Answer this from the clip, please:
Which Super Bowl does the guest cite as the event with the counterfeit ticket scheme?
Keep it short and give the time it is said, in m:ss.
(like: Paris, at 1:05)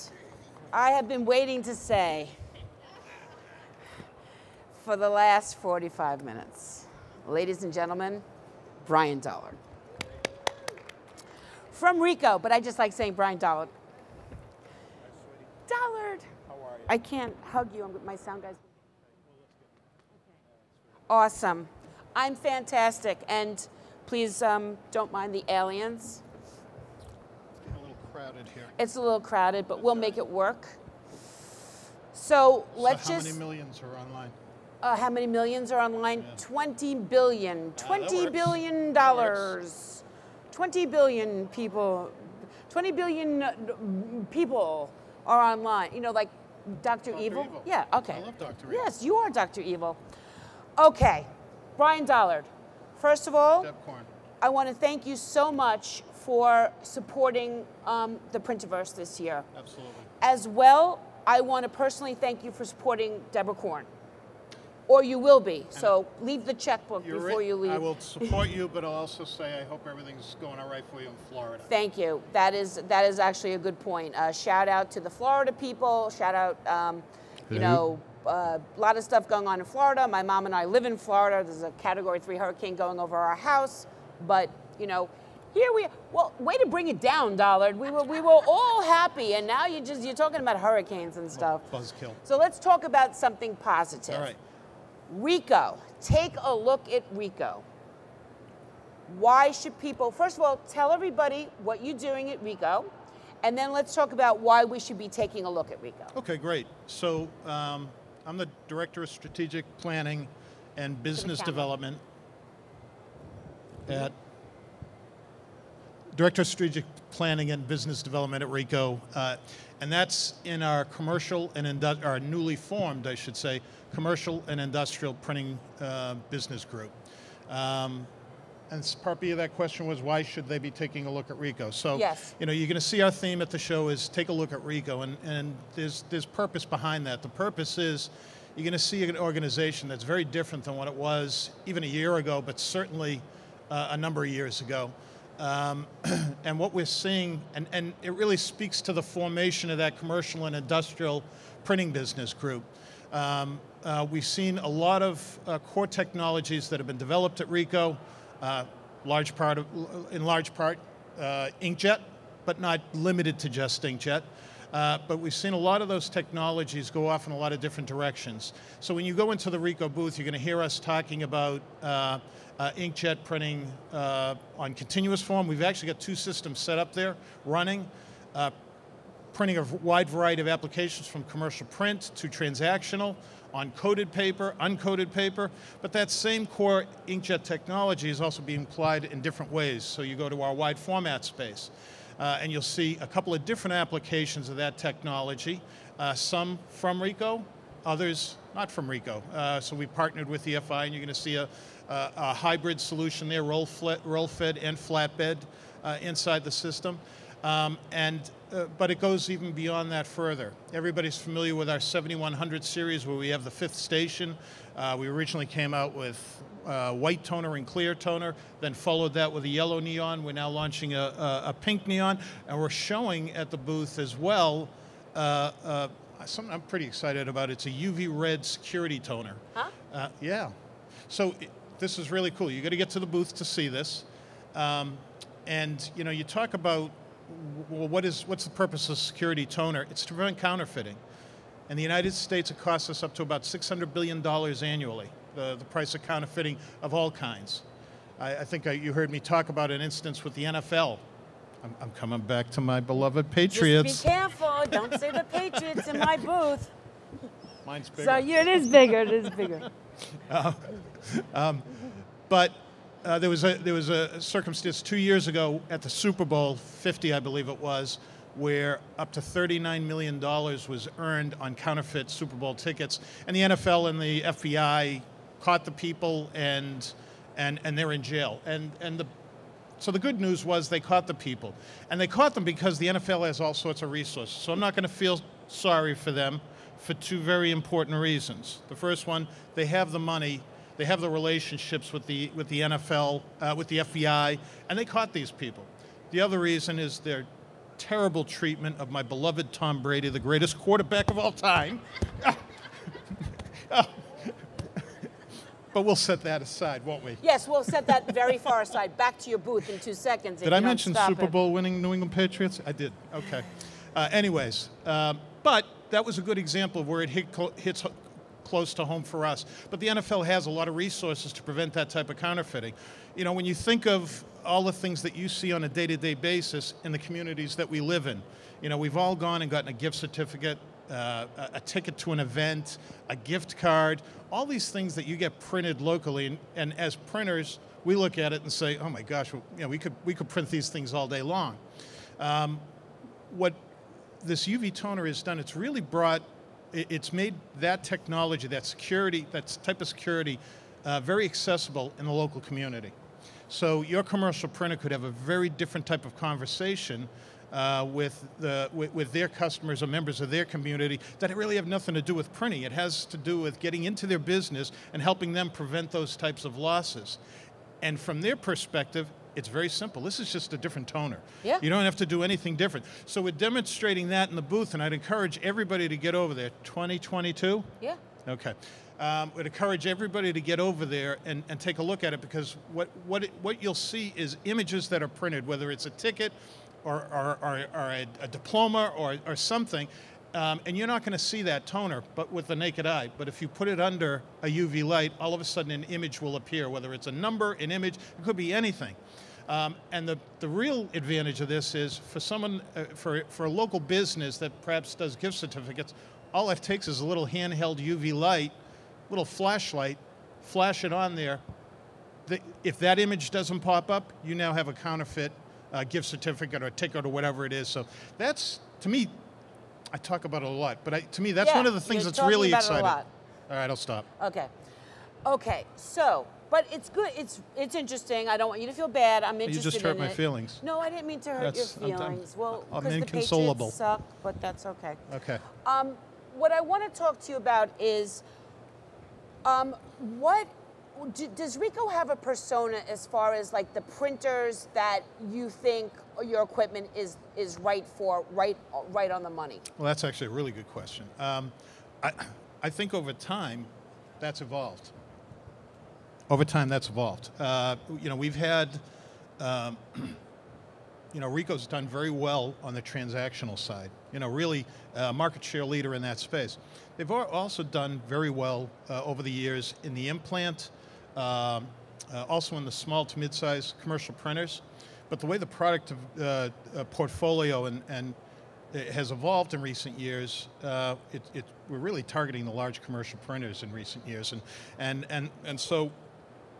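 Super Bowl 50, at 4:25.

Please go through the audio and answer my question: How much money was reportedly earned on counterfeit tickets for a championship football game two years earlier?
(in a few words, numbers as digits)
$39 million.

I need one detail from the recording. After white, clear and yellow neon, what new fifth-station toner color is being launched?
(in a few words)
pink neon.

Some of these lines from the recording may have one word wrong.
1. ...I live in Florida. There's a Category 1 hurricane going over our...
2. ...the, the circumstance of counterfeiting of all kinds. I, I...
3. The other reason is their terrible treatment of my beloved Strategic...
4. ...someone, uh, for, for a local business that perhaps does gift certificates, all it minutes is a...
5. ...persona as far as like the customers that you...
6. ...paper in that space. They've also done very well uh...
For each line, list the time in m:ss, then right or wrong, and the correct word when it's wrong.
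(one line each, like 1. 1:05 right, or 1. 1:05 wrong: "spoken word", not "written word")
1. 1:20 wrong: "3", not "1"
2. 4:05 wrong: "price", not "circumstance"
3. 4:56 wrong: "Tom", not "Strategic"
4. 6:42 wrong: "takes", not "minutes"
5. 7:22 wrong: "printers", not "customers"
6. 7:45 wrong: "leader", not "paper".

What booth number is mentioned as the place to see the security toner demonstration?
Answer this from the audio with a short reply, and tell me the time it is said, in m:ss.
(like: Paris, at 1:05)
2022, at 6:16.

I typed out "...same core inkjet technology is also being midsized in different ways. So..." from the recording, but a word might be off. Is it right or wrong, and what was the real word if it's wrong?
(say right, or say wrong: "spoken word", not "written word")
wrong: "applied", not "midsized".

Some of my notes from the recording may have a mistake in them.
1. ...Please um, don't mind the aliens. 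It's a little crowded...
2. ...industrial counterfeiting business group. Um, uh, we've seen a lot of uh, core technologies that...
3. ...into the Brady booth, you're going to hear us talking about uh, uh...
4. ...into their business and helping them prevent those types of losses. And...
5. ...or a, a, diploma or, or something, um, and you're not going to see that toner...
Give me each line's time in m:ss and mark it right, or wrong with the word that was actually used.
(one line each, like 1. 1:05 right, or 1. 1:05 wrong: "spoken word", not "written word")
1. 0:24 right
2. 2:30 wrong: "printing", not "counterfeiting"
3. 2:49 wrong: "Ricoh", not "Brady"
4. 6:03 right
5. 6:27 right.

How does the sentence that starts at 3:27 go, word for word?
Um, and, uh, but it goes even beyond that further.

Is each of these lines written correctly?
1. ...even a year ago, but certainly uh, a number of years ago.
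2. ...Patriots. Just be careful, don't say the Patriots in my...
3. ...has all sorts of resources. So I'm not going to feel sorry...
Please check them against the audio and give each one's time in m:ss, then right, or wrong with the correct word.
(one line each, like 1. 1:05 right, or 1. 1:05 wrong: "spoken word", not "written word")
1. 2:21 right
2. 4:13 right
3. 4:43 right.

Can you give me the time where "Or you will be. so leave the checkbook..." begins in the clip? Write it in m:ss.
1:04.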